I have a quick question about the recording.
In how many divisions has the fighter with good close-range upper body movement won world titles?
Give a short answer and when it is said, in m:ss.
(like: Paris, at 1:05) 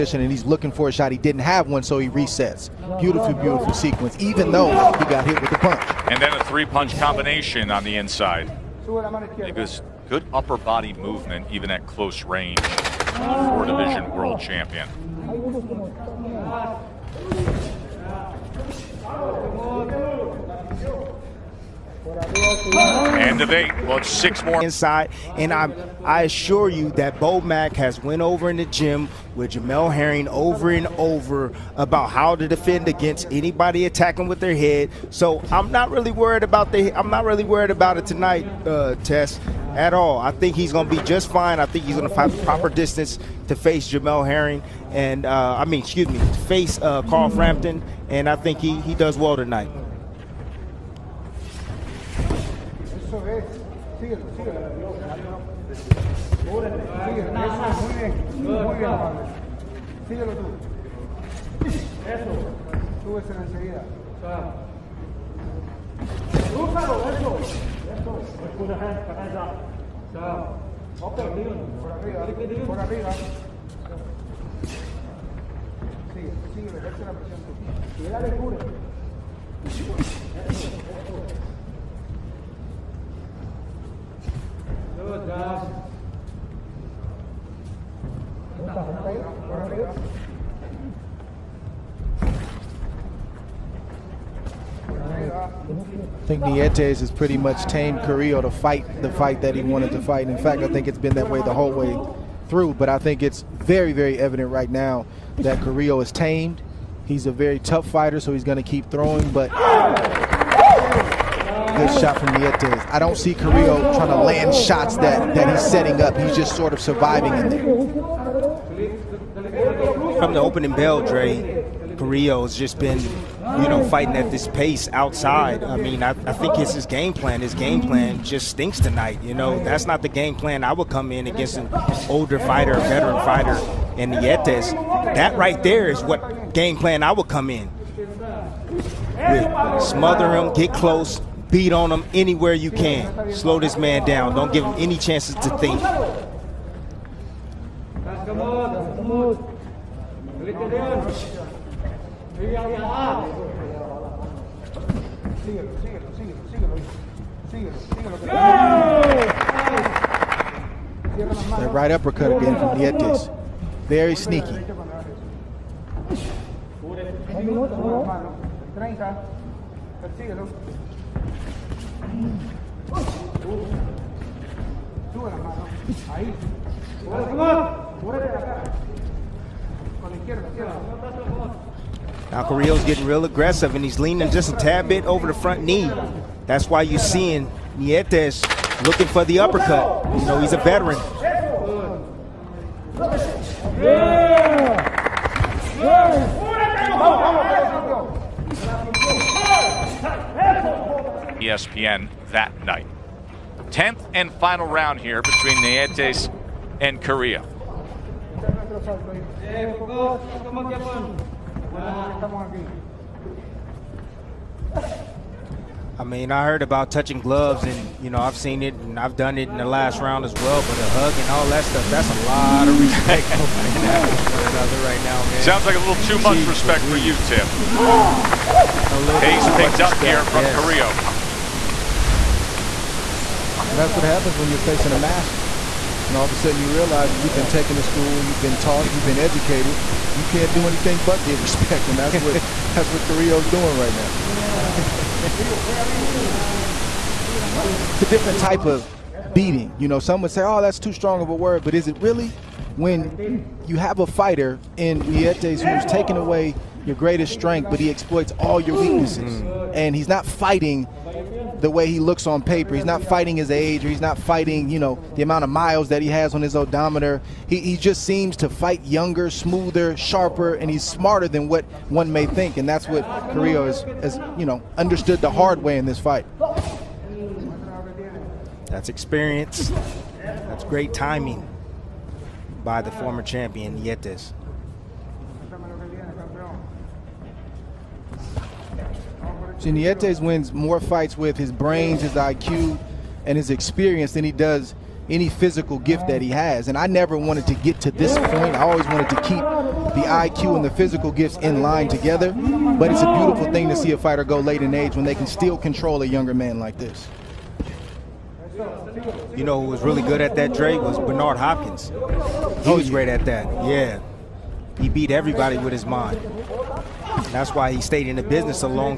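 4, at 0:12.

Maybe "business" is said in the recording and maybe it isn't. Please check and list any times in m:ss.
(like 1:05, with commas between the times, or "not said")
5:18.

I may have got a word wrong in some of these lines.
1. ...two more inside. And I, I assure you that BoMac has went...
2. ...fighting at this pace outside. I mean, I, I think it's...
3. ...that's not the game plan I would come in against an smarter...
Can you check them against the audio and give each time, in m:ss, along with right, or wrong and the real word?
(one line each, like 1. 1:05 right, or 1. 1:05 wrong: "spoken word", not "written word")
1. 0:24 wrong: "six", not "two"
2. 2:03 right
3. 2:09 wrong: "older", not "smarter".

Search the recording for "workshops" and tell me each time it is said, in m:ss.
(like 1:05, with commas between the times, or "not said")
not said.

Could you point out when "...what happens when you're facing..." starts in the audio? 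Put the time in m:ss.
3:53.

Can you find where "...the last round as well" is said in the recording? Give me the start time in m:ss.
3:39.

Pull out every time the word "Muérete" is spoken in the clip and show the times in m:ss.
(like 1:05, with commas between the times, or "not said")
2:58.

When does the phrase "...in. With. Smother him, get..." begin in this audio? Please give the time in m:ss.
2:17.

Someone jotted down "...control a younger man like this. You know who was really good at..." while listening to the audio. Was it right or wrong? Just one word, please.
right.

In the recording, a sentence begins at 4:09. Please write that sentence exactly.
You know, some would say, oh, that's too strong of a word, but is it really?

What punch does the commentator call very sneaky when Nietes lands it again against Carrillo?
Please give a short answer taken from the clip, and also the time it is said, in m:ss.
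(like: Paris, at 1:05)
Right uppercut, at 2:41.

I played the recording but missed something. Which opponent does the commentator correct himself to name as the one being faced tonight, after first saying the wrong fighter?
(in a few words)
Carl Frampton.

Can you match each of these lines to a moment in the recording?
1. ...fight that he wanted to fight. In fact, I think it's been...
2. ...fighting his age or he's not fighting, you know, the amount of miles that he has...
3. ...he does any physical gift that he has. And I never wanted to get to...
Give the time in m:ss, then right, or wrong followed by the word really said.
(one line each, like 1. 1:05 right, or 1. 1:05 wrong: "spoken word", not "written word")
1. 1:39 right
2. 4:23 right
3. 4:54 right.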